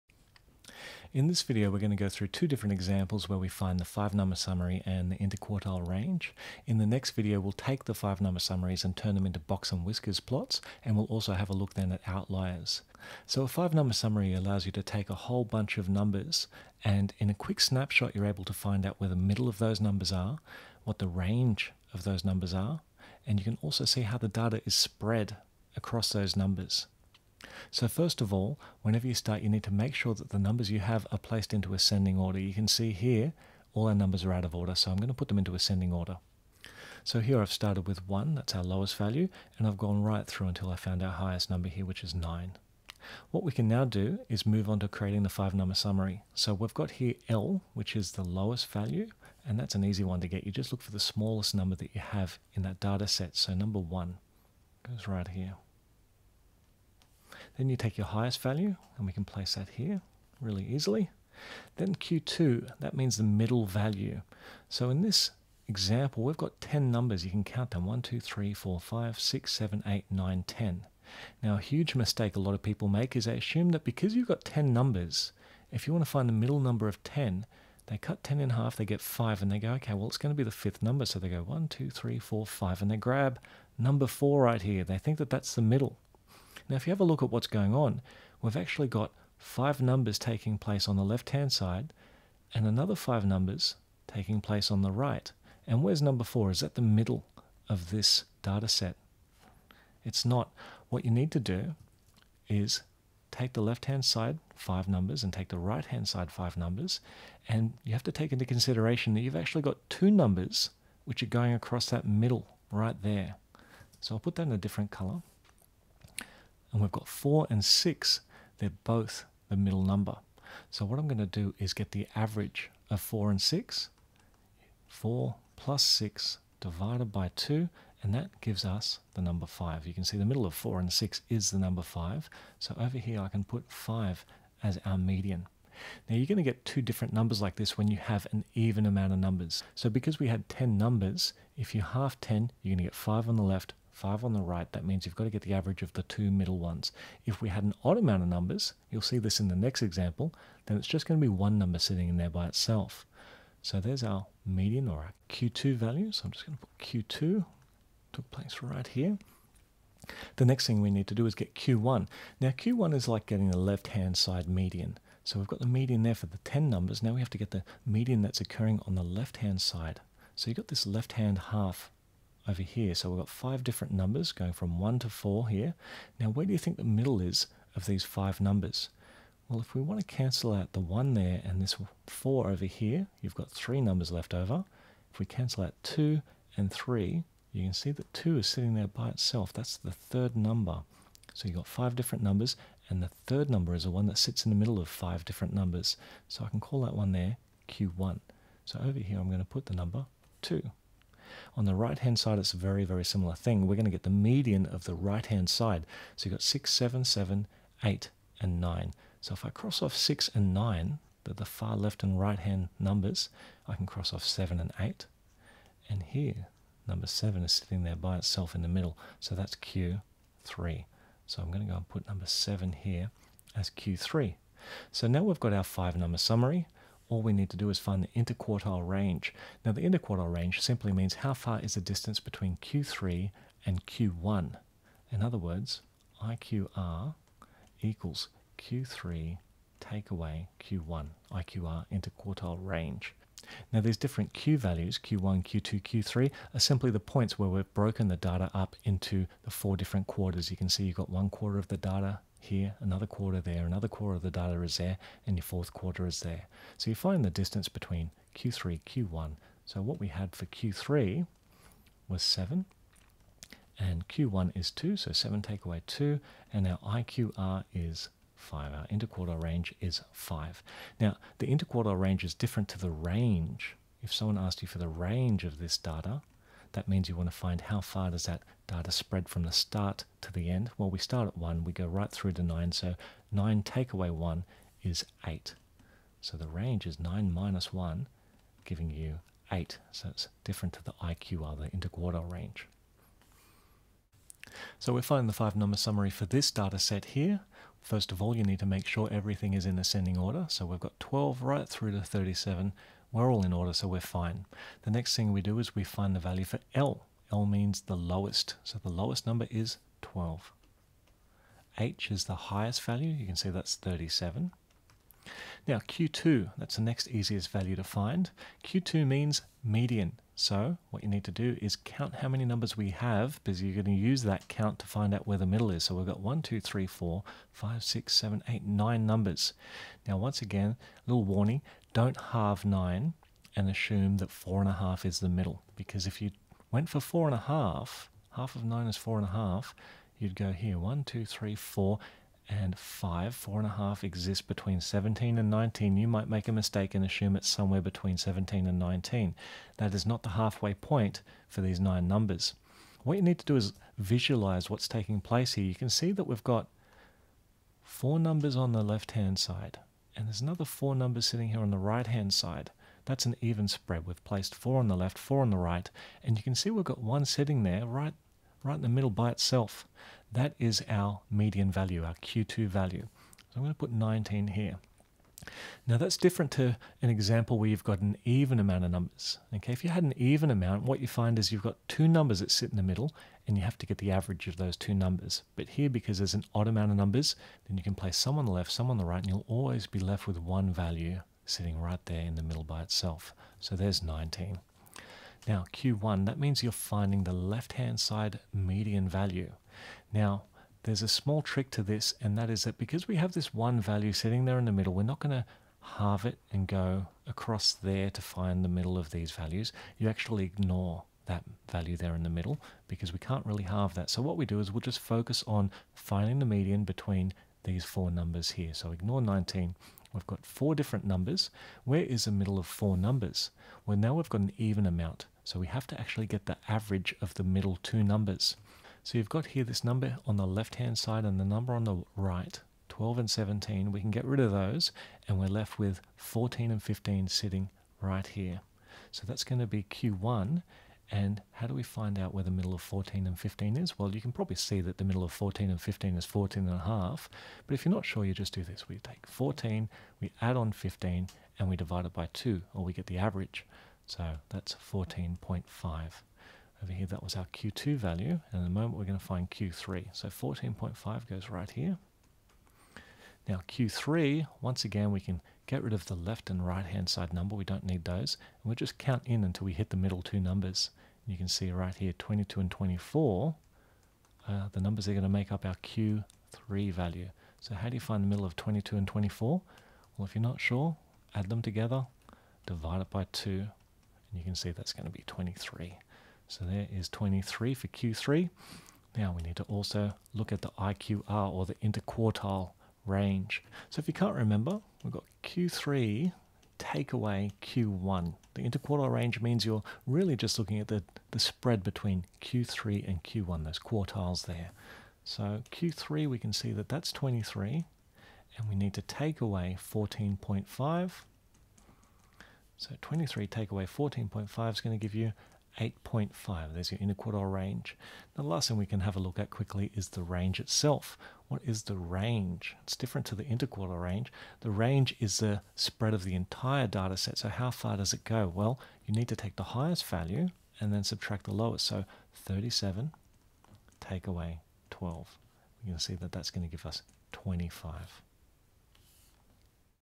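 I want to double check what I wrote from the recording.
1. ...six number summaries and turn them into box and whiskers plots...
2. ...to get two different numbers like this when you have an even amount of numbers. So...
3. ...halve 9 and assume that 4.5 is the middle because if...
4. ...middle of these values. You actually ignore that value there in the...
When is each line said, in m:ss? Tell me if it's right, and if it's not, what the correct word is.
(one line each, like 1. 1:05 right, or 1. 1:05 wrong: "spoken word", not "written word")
1. 0:07 wrong: "five", not "six"
2. 2:16 right
3. 5:32 right
4. 6:48 right.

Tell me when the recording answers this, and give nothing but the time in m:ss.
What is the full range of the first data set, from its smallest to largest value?
4:43.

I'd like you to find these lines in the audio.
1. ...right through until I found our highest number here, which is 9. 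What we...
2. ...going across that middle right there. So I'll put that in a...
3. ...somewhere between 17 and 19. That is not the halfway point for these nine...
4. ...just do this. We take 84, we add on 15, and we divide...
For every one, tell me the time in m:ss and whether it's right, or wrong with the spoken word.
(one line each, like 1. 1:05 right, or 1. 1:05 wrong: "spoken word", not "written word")
1. 0:40 right
2. 1:51 right
3. 5:47 right
4. 7:28 wrong: "14", not "84".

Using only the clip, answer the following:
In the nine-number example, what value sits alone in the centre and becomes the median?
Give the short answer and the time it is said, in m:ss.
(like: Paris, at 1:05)
19, at 6:13.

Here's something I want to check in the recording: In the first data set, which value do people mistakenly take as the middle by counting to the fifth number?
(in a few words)
4.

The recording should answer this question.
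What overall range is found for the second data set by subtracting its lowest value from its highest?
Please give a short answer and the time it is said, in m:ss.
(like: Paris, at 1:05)
25, at 8:56.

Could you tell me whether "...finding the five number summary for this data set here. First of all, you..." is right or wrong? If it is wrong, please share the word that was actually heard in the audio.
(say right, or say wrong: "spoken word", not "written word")
right.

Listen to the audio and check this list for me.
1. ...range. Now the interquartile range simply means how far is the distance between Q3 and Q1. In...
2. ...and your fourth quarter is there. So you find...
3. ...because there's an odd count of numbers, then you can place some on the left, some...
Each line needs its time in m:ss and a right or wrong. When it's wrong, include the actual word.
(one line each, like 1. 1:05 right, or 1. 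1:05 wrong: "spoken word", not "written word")
1. 3:48 right
2. 4:15 right
3. 6:25 wrong: "amount", not "count".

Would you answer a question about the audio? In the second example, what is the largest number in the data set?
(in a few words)
37.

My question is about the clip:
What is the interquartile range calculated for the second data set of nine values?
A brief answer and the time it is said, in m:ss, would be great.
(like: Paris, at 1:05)
8.5, at 8:35.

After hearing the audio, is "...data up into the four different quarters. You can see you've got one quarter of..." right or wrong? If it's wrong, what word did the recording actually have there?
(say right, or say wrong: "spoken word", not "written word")
right.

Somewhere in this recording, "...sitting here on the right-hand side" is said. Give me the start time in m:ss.
6:01.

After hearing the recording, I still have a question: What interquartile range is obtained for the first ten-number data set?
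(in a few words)
5.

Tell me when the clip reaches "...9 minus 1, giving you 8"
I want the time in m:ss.
4:46.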